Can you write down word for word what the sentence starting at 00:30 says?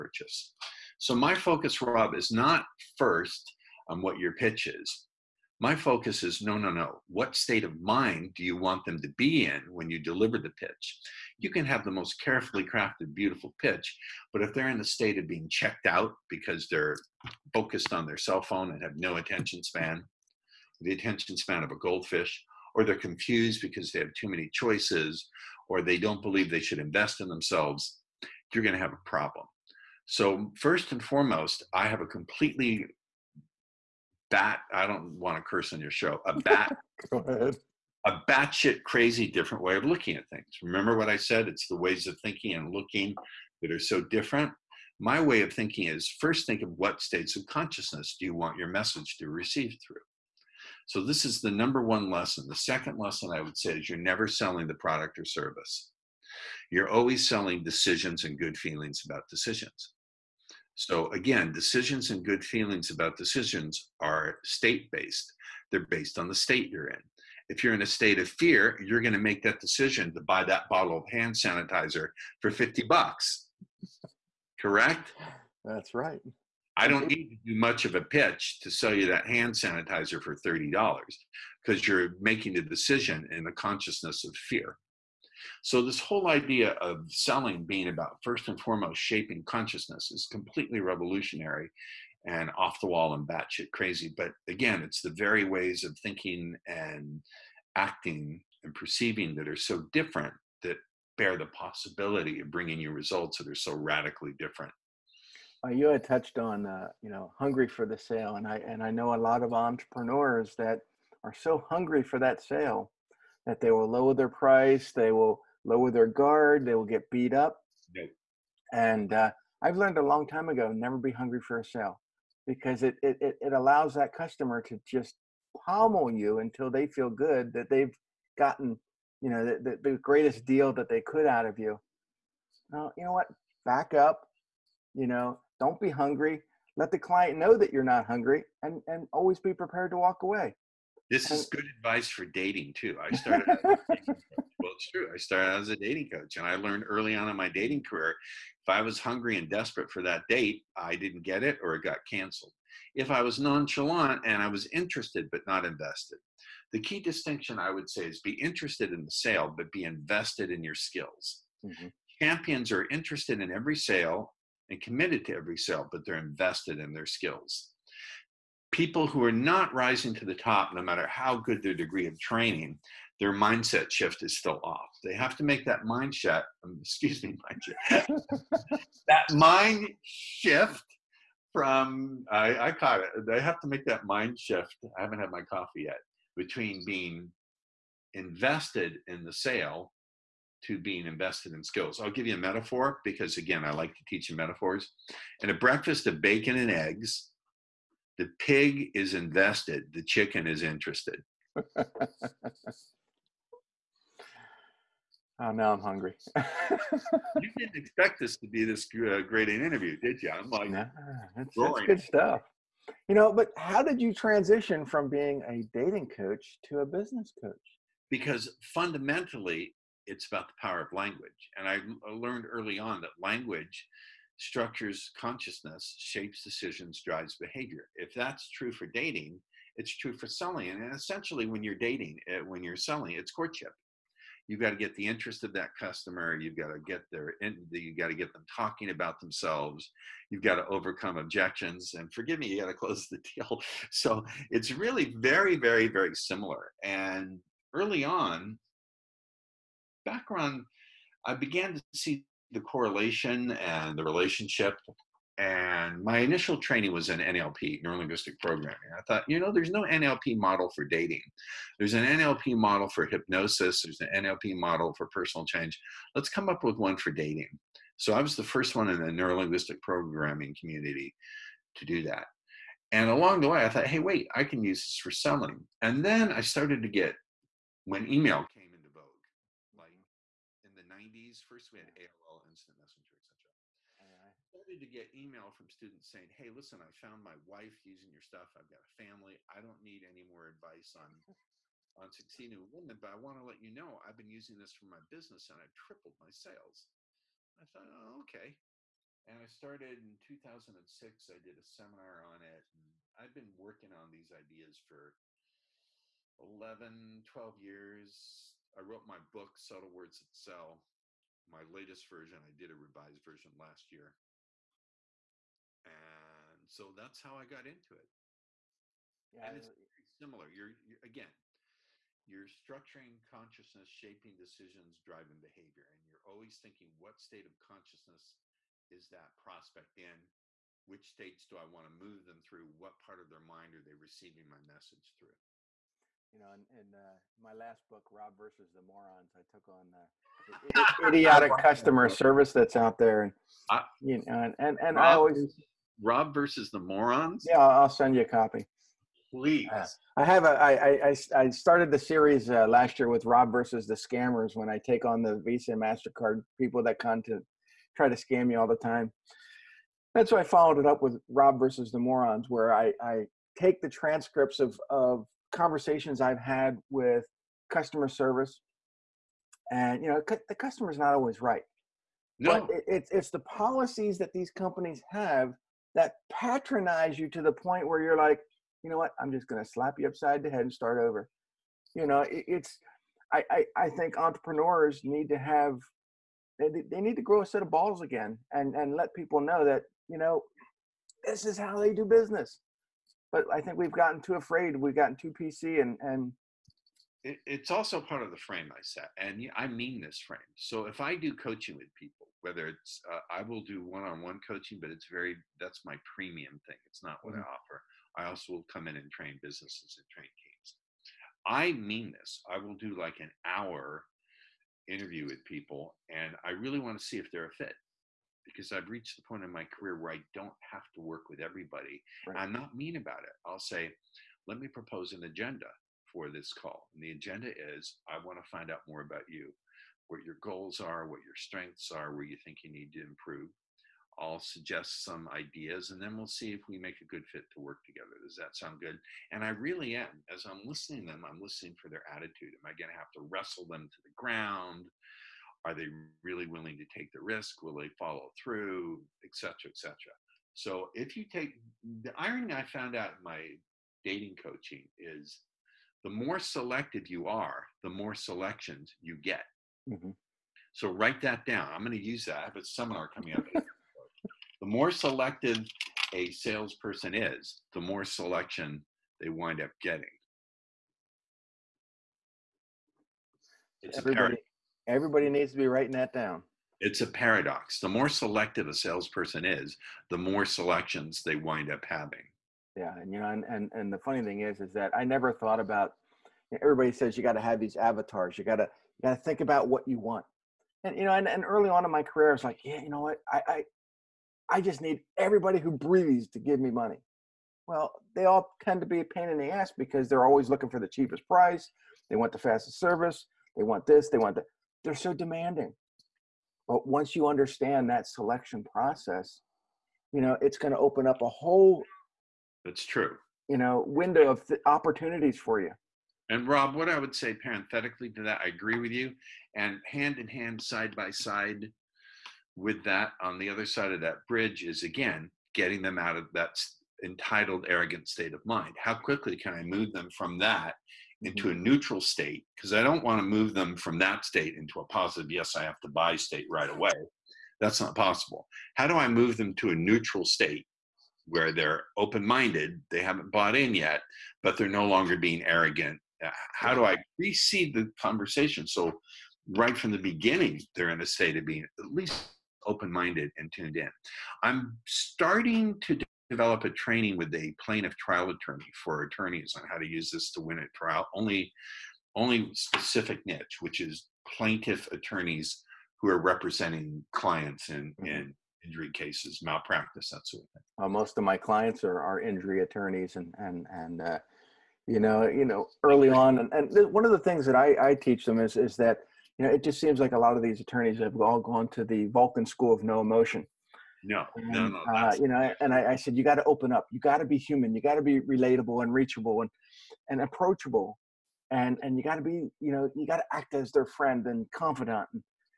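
So, first and foremost, I have a completely bat.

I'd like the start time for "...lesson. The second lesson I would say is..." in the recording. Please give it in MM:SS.
00:52.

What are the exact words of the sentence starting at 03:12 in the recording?
I'll give you a metaphor because, again, I like to teach you metaphors.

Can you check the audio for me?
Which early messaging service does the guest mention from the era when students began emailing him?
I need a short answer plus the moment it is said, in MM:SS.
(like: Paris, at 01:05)
AOL Instant Messenger, at 04:41.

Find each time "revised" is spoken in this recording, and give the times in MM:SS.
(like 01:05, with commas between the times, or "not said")
05:12.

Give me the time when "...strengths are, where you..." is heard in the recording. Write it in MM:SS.
07:11.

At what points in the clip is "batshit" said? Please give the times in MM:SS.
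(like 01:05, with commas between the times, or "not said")
00:38, 01:33.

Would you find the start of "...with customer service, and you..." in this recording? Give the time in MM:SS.
06:06.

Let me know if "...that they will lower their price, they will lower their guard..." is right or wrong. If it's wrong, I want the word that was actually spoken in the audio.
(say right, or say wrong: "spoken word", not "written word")
right.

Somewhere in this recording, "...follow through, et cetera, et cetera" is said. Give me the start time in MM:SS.
07:27.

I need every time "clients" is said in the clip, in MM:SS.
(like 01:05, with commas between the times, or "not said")
02:16, 09:27, 09:31.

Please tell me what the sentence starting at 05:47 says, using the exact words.
Yeah, I'll send you a copy.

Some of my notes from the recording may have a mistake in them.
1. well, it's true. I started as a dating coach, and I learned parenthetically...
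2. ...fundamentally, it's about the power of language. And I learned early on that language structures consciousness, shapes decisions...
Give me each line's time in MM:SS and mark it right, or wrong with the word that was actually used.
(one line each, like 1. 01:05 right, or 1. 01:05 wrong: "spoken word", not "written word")
1. 02:23 wrong: "early", not "parenthetically"
2. 03:38 right.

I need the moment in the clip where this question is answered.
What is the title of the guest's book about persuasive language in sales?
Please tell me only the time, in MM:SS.
05:09.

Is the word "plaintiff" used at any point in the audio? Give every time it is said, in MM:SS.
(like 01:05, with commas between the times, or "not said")
09:17, 09:24.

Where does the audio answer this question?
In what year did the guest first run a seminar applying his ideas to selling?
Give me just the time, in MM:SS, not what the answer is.
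05:00.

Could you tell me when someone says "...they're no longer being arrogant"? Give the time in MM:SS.
09:04.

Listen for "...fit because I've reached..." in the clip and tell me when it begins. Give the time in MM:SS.
06:57.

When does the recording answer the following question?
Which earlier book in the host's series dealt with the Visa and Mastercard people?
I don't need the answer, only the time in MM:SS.
05:53.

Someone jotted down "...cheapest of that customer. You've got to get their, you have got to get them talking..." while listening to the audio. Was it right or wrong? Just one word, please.
wrong.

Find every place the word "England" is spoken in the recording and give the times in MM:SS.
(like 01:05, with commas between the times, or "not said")
not said.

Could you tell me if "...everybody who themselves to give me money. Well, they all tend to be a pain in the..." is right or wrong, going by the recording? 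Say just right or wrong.
wrong.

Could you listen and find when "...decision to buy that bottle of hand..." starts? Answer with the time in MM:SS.
01:09.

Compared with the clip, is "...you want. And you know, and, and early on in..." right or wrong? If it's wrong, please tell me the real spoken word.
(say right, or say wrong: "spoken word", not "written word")
right.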